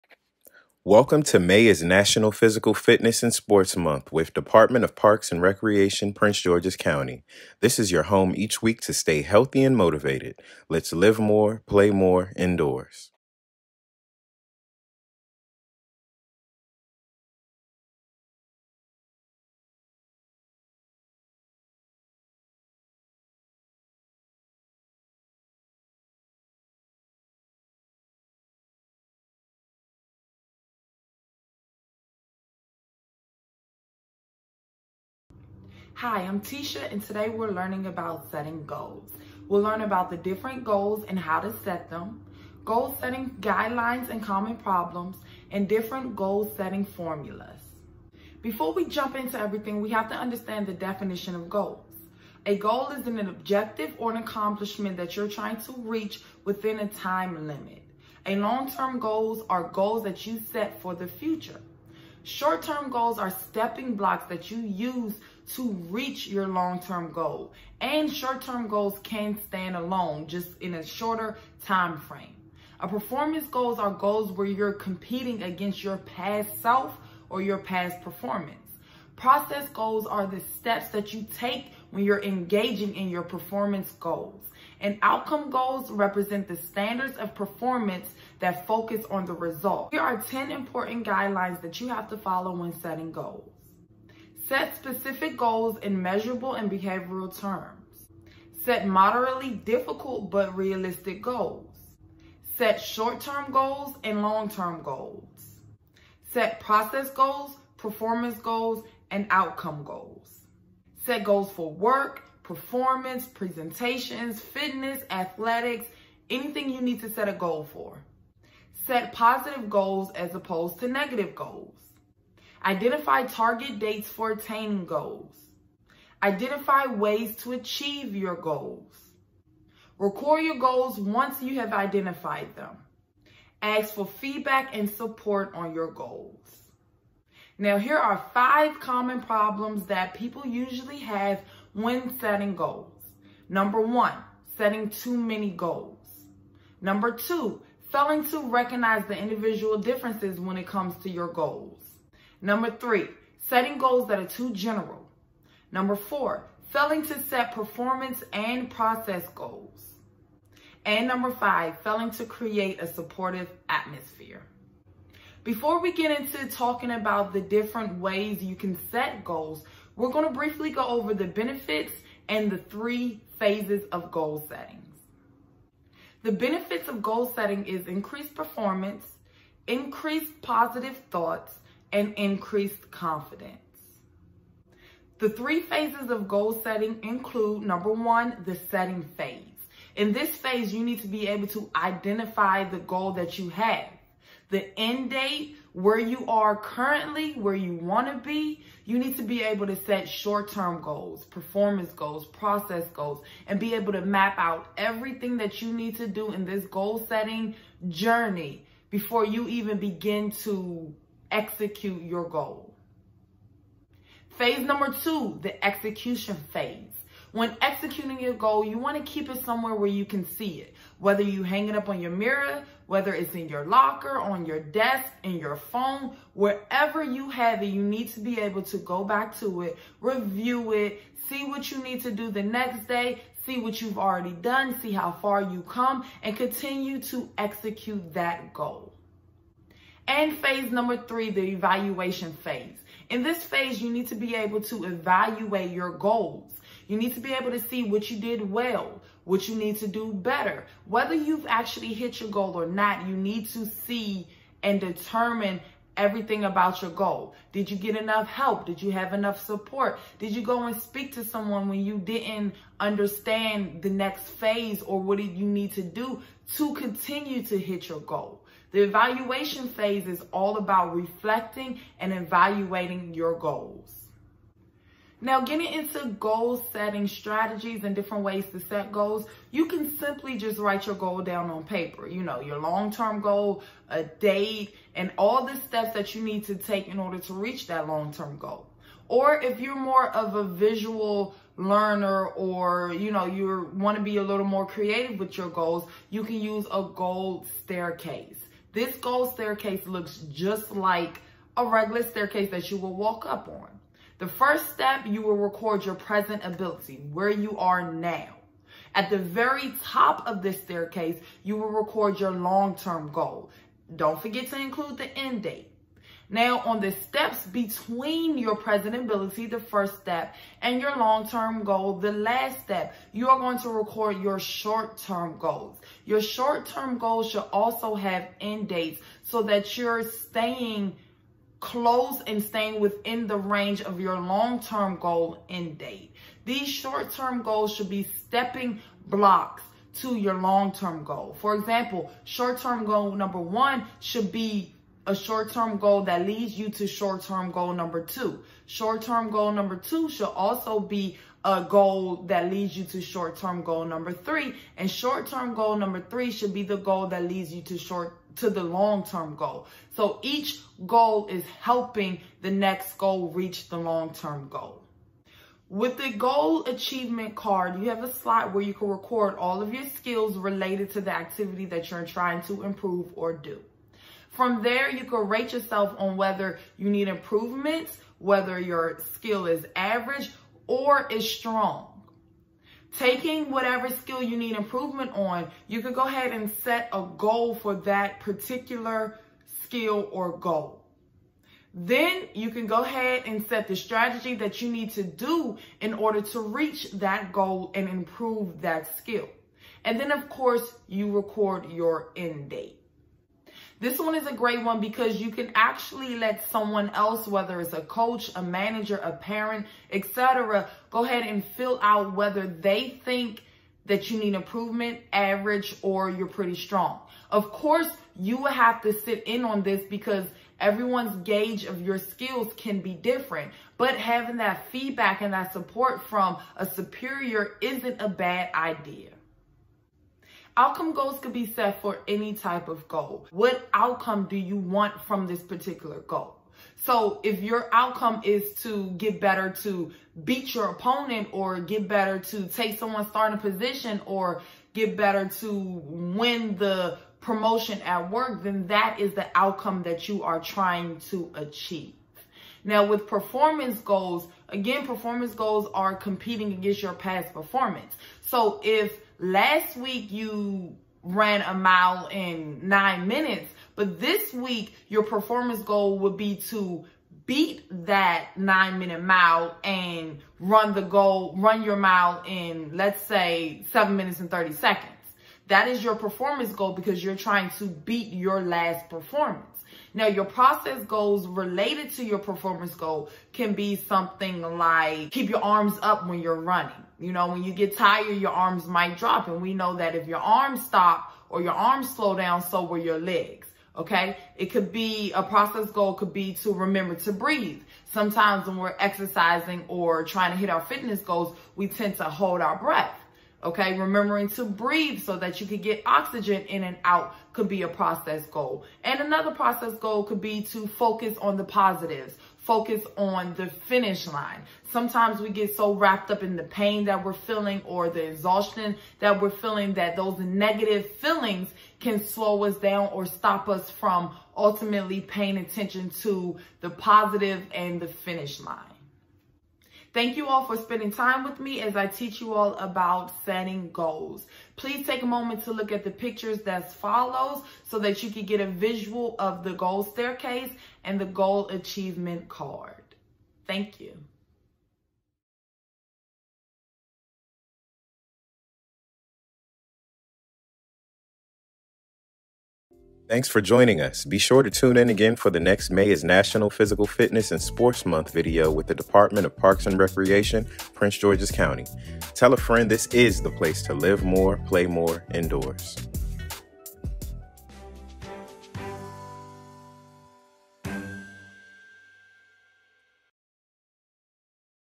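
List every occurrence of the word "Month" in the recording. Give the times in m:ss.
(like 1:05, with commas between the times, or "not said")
0:03, 9:17.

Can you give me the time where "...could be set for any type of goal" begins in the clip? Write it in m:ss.
7:11.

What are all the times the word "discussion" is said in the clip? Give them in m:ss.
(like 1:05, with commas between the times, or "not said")
not said.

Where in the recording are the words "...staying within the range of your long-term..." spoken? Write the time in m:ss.
5:32.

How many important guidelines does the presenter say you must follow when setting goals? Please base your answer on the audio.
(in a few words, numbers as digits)
10.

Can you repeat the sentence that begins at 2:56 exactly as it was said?
The benefits of goal setting is increased performance, increased positive thoughts, and increased confidence.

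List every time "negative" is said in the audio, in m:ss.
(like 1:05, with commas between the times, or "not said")
2:00, 8:40.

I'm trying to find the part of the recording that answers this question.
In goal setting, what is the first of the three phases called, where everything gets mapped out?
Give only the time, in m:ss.
3:08.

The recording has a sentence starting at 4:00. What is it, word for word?
And phase number three, the evaluation phase.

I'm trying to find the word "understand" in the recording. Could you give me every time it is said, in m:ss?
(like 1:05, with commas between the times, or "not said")
0:50, 4:22.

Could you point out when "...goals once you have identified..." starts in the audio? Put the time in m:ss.
2:10.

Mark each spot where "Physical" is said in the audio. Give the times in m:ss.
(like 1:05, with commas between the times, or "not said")
0:02, 9:16.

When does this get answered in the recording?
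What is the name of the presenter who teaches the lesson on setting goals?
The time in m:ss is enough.
0:36.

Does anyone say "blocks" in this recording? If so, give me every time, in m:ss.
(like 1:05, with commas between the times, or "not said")
1:03, 5:39.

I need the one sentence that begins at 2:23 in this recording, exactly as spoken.
Number one, setting too many goals.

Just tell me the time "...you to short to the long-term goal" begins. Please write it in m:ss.
5:57.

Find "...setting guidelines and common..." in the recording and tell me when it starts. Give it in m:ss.
0:42.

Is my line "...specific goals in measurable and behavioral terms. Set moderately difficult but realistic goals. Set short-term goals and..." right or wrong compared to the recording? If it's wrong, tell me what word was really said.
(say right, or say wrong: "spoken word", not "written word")
right.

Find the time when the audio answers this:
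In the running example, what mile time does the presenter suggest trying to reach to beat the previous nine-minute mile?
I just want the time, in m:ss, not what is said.
7:53.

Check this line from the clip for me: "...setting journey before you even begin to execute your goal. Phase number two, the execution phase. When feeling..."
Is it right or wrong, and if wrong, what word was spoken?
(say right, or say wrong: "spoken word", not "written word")
wrong: "executing", not "feeling".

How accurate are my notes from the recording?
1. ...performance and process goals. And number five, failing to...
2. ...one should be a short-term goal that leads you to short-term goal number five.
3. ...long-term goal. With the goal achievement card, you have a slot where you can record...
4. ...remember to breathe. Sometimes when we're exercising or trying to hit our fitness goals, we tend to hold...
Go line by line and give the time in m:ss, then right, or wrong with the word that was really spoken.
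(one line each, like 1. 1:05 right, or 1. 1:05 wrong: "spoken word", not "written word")
1. 2:37 right
2. 5:43 wrong: "two", not "five"
3. 6:03 right
4. 8:16 right.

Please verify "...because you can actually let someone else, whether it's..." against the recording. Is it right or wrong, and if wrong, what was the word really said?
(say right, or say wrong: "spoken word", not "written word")
right.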